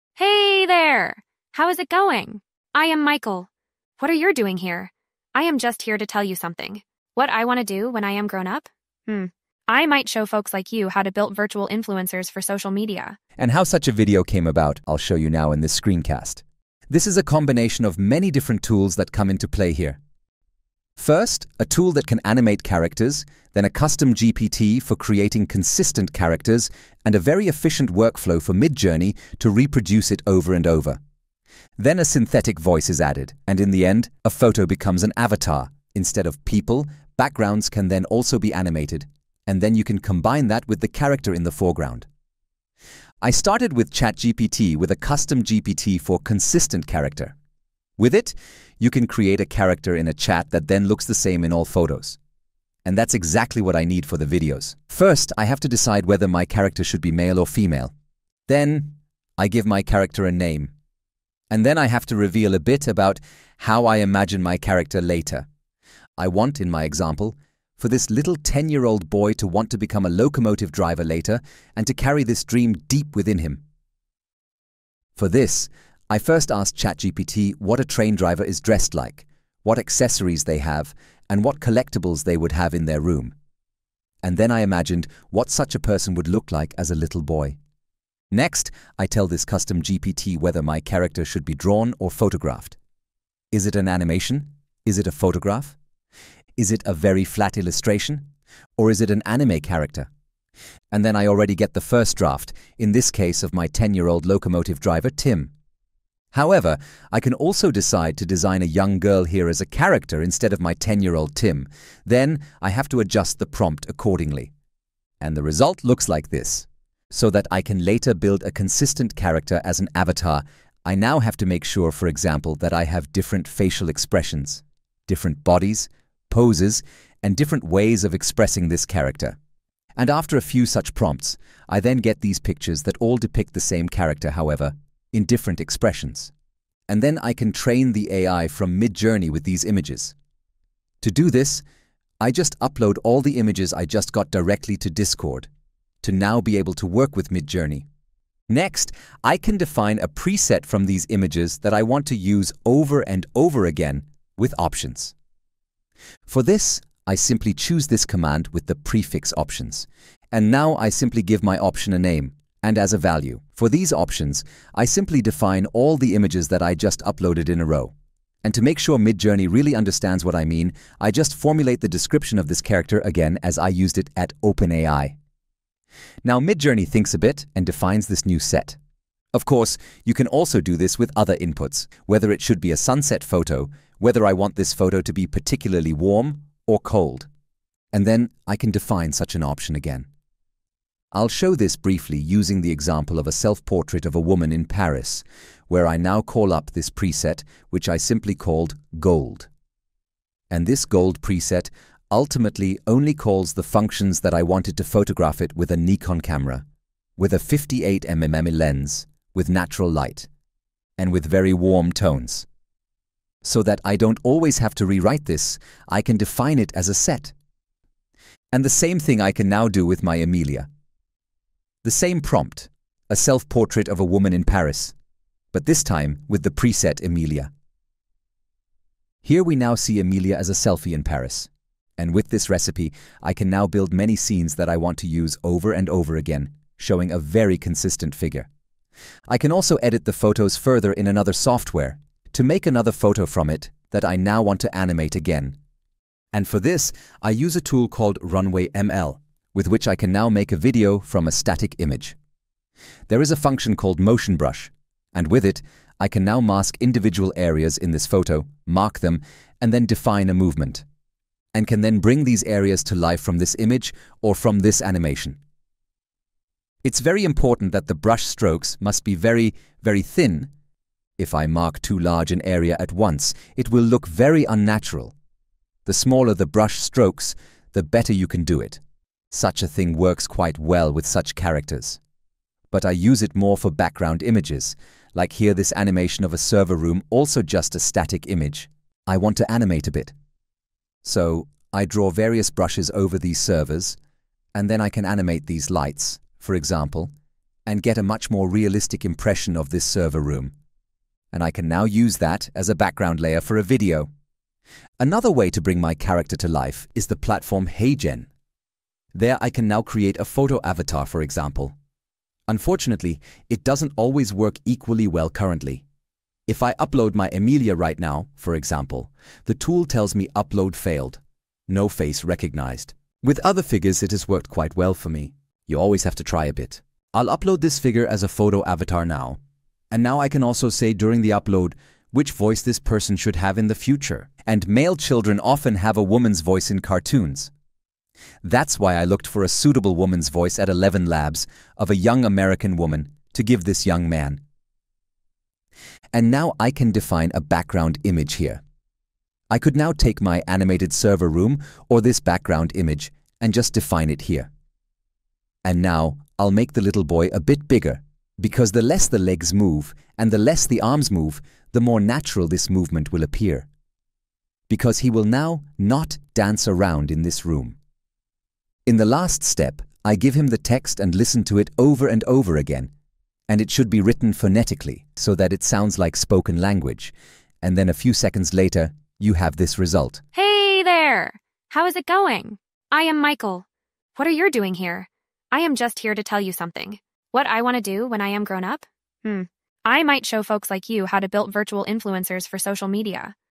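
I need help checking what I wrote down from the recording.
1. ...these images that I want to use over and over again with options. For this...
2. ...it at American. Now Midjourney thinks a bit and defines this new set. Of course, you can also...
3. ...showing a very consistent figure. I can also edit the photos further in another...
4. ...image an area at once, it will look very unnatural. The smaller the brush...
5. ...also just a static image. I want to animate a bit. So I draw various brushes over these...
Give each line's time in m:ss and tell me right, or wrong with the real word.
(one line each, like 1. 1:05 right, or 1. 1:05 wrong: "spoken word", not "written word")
1. 2:30 right
2. 2:53 wrong: "OpenAI", not "American"
3. 3:56 right
4. 4:31 wrong: "large", not "image"
5. 4:47 right.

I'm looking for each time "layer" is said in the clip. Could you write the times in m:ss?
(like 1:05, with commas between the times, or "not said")
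5:03.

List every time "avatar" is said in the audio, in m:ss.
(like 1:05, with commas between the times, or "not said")
0:35, 1:59, 5:10, 5:28.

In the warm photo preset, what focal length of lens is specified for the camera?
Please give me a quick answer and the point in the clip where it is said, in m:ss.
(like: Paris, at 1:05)
58mm, at 3:27.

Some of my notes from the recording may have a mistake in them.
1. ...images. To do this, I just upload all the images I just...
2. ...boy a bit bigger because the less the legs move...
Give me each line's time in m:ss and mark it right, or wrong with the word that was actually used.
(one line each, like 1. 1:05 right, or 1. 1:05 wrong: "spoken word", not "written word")
1. 2:19 right
2. 5:57 right.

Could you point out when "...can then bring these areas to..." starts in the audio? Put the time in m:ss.
4:21.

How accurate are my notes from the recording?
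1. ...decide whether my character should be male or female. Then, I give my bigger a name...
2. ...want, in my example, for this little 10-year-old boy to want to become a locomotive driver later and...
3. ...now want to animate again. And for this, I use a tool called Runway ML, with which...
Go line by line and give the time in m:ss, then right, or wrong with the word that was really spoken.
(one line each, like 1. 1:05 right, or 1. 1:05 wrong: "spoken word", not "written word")
1. 0:55 wrong: "character", not "bigger"
2. 1:06 right
3. 4:04 right.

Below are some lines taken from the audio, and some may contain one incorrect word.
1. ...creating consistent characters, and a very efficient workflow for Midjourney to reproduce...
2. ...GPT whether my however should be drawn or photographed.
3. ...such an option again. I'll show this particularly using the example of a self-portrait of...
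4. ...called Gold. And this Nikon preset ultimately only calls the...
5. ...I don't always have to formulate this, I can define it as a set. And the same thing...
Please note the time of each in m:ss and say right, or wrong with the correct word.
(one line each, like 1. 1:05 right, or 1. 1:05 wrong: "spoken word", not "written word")
1. 0:24 right
2. 1:29 wrong: "character", not "however"
3. 3:09 wrong: "briefly", not "particularly"
4. 3:18 wrong: "Gold", not "Nikon"
5. 3:33 wrong: "rewrite", not "formulate".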